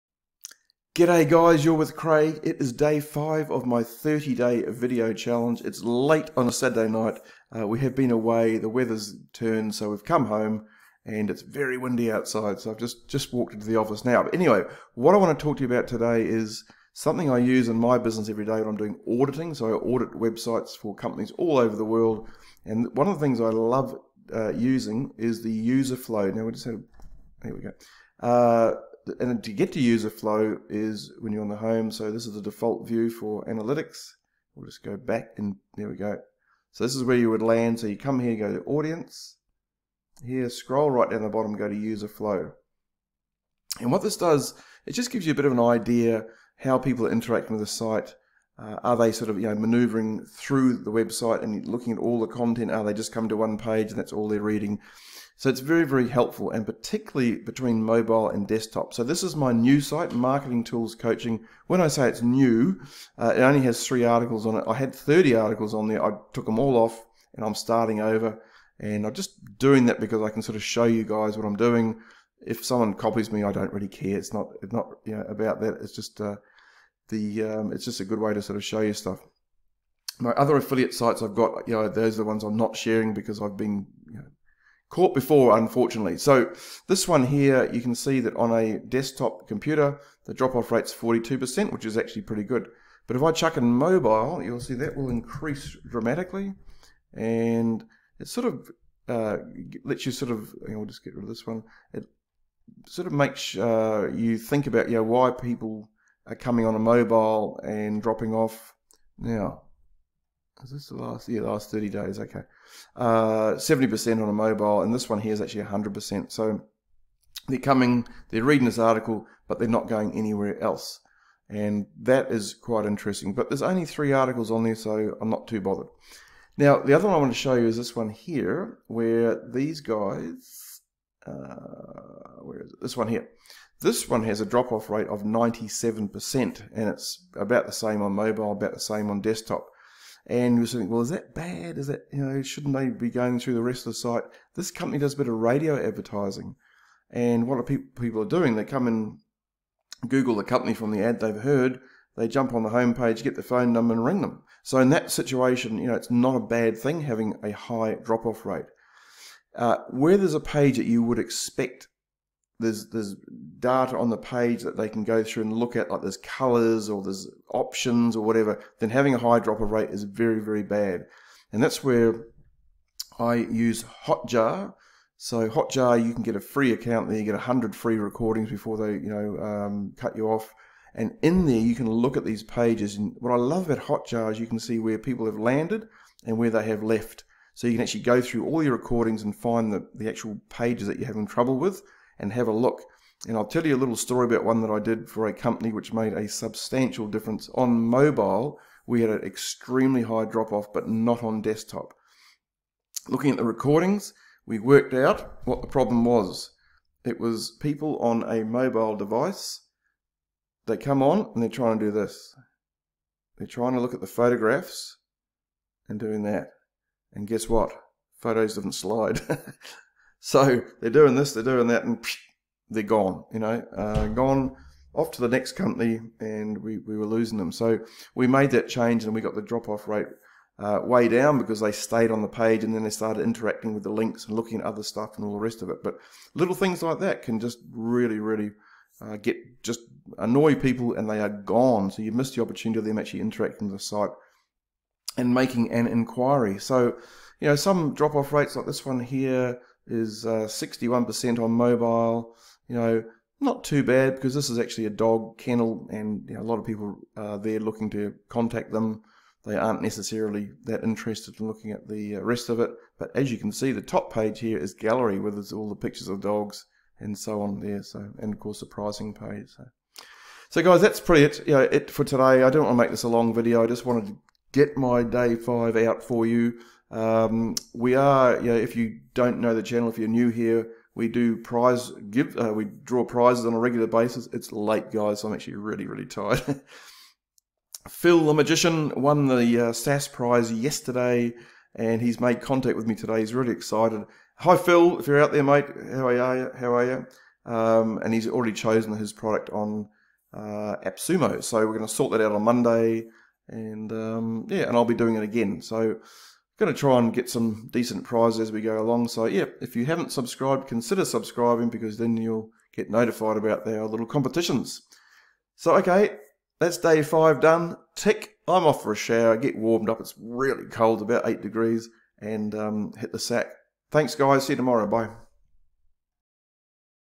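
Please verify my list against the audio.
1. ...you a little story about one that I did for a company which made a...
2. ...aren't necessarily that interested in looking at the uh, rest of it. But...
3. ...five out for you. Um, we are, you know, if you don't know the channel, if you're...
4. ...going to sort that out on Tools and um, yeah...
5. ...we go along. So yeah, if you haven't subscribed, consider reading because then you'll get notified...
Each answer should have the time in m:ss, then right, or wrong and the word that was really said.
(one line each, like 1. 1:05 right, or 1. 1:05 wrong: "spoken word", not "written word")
1. 3:13 right
2. 4:19 right
3. 4:35 right
4. 5:01 wrong: "Monday", not "Tools"
5. 5:08 wrong: "subscribing", not "reading".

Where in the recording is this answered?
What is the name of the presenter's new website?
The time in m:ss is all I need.
1:00.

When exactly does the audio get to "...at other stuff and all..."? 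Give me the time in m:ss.
3:54.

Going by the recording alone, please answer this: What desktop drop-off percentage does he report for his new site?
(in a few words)
42%.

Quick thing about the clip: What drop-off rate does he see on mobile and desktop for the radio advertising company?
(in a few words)
97%.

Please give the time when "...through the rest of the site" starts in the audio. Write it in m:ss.
2:23.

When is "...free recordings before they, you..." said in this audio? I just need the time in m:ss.
2:57.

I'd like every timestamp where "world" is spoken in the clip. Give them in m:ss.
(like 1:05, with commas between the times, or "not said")
0:21.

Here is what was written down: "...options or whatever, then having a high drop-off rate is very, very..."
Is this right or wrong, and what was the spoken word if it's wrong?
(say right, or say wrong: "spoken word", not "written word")
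right.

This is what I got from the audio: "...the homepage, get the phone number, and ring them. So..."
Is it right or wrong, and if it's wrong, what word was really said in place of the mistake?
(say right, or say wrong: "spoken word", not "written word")
right.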